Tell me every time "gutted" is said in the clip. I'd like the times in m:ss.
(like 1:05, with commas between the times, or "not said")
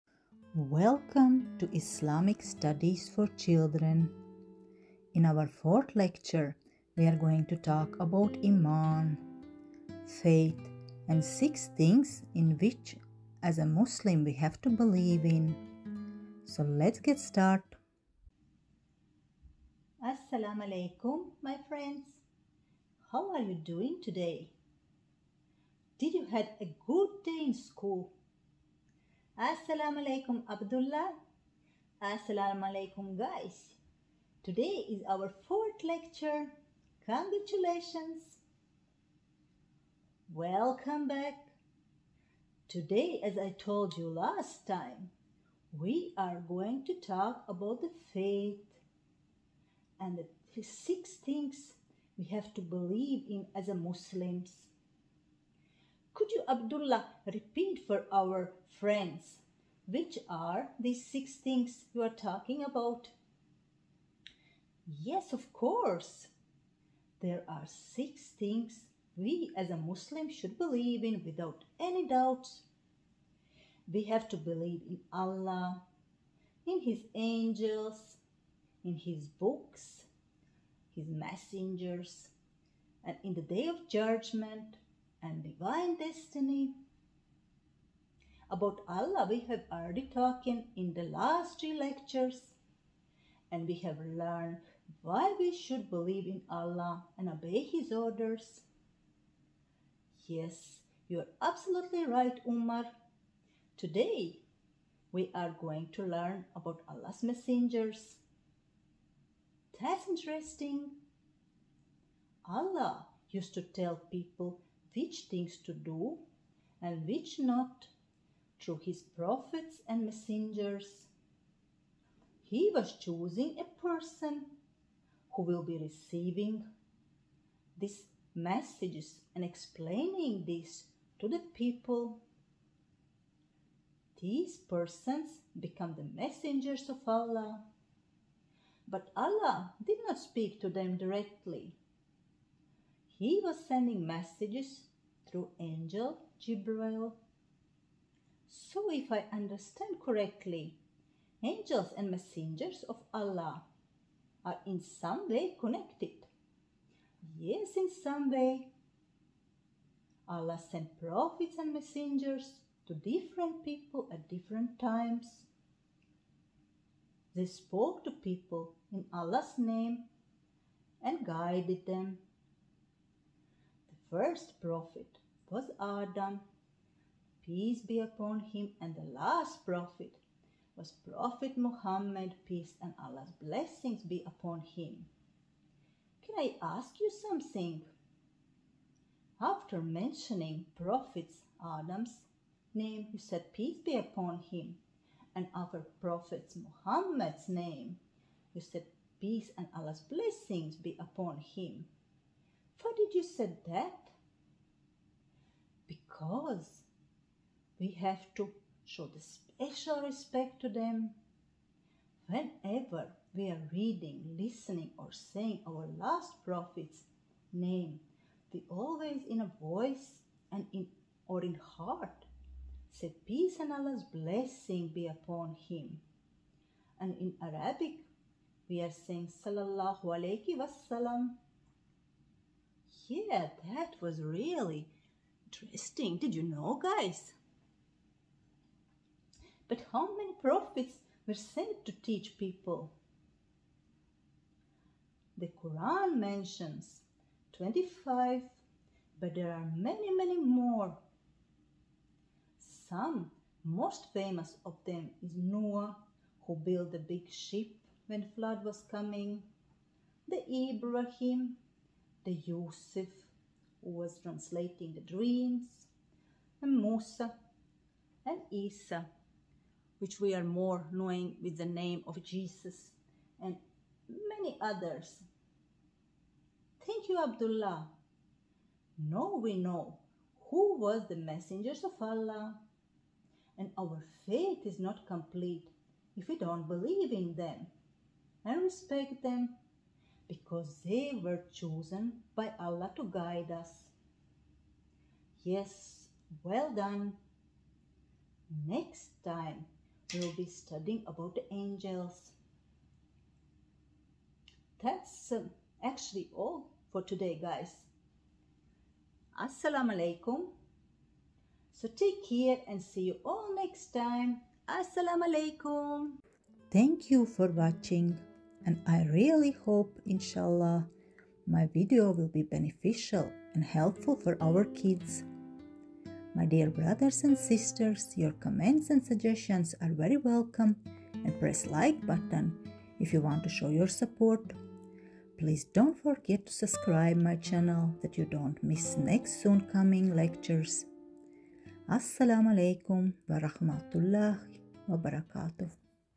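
not said.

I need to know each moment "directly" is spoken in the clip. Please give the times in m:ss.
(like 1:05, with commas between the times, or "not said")
2:20.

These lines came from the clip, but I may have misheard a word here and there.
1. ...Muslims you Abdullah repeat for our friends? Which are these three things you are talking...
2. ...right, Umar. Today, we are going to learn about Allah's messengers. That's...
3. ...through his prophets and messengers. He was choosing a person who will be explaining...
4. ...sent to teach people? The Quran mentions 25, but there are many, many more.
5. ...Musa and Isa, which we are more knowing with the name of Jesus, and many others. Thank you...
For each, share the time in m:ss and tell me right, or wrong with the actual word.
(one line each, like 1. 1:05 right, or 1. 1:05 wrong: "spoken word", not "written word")
1. 0:53 wrong: "six", not "three"
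2. 1:42 right
3. 1:58 wrong: "receiving", not "explaining"
4. 4:01 right
5. 4:26 right.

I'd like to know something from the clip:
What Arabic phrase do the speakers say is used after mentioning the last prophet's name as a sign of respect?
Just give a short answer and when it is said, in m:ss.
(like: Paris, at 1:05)
Sallallahu Alaihi Wasallam, at 3:49.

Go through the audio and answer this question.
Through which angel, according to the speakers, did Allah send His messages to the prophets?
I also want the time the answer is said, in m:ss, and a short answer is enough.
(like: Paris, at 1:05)
Jibril, at 2:26.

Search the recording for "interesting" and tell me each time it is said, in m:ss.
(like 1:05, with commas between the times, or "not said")
1:50, 3:55.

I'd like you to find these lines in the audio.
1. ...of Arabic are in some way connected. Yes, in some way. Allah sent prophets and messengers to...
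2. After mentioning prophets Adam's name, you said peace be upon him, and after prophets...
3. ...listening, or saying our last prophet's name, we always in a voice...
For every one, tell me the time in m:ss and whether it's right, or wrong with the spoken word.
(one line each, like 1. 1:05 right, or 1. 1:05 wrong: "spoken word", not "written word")
1. 2:32 wrong: "Allah", not "Arabic"
2. 3:09 right
3. 3:34 right.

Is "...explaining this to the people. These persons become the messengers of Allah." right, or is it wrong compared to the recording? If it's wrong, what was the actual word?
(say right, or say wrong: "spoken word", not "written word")
right.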